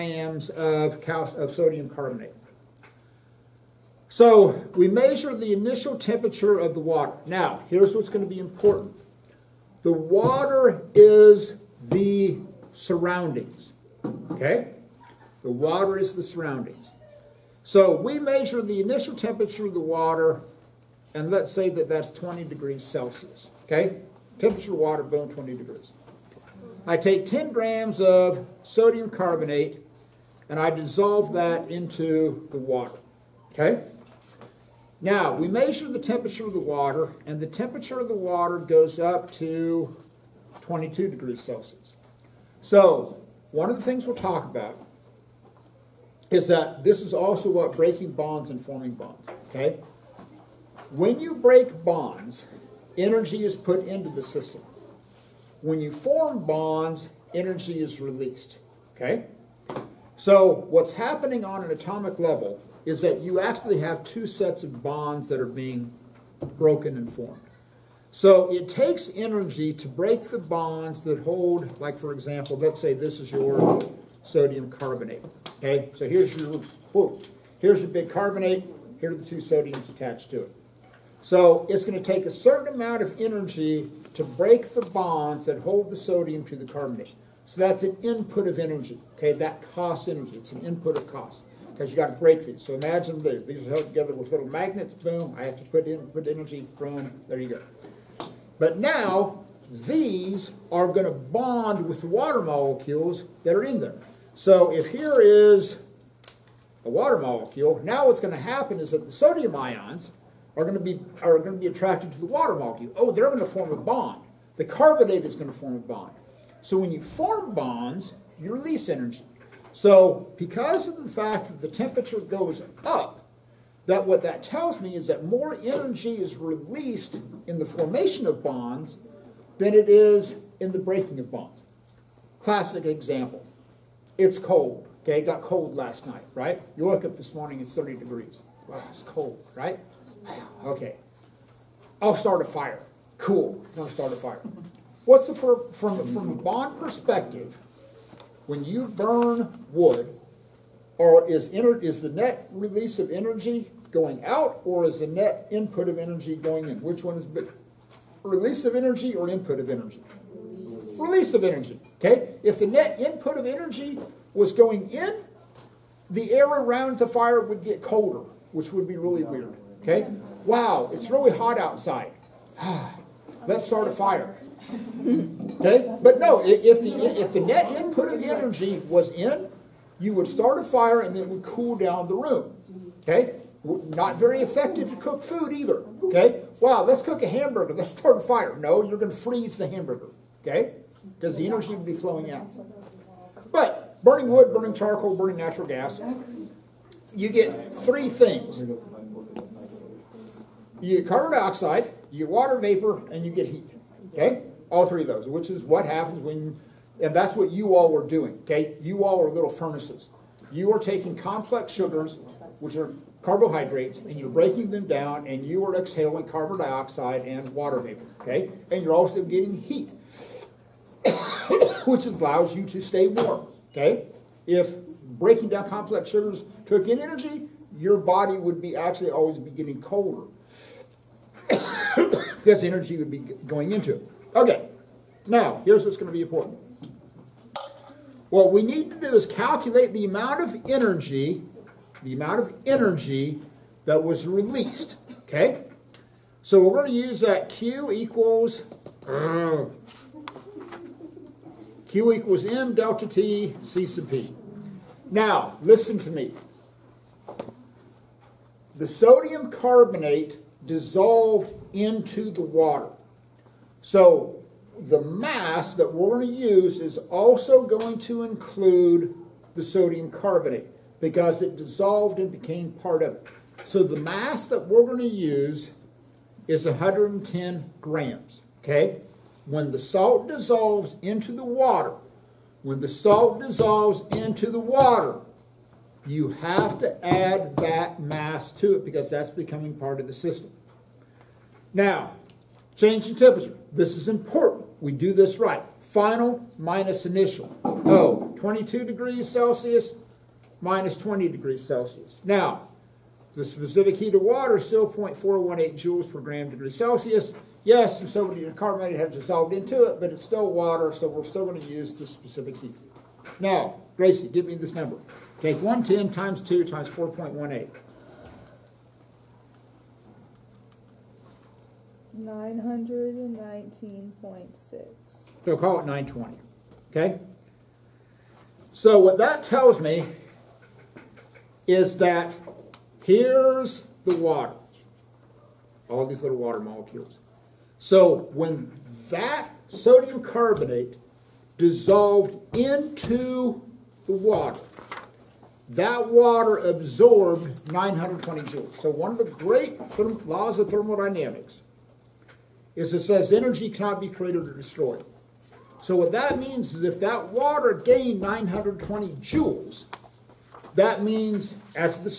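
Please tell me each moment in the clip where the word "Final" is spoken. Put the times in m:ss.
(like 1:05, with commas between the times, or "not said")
4:55.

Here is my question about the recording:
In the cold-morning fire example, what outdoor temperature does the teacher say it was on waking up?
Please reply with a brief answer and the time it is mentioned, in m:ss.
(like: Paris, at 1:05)
30 degrees, at 2:17.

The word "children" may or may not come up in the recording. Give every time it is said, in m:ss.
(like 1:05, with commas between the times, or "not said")
not said.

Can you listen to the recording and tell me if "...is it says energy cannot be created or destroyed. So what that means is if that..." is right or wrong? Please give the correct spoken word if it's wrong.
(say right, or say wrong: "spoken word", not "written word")
right.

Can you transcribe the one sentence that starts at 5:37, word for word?
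So when that sodium carbonate dissolved into the water, that water absorbed 920 joules.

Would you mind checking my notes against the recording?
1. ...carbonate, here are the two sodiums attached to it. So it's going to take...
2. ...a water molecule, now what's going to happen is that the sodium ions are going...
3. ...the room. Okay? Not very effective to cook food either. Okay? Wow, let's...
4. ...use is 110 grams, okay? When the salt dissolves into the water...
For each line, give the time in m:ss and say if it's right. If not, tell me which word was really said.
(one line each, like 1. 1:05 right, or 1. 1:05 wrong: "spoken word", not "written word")
1. 1:18 right
2. 1:46 right
3. 3:02 right
4. 4:35 right.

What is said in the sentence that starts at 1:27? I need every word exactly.
So that's an input of energy, okay?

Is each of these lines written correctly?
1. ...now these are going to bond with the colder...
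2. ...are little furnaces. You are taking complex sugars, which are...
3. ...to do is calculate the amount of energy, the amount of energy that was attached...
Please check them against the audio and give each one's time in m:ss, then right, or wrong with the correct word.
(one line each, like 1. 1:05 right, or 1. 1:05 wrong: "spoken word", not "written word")
1. 1:38 wrong: "water", not "colder"
2. 3:29 right
3. 3:58 wrong: "released", not "attached".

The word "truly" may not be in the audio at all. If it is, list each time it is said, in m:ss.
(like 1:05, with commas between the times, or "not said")
not said.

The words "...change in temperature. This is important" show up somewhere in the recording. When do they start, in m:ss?
4:52.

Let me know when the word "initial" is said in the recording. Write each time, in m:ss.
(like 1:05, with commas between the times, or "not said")
0:05, 0:18, 4:57.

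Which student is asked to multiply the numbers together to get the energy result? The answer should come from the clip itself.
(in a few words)
Gracie.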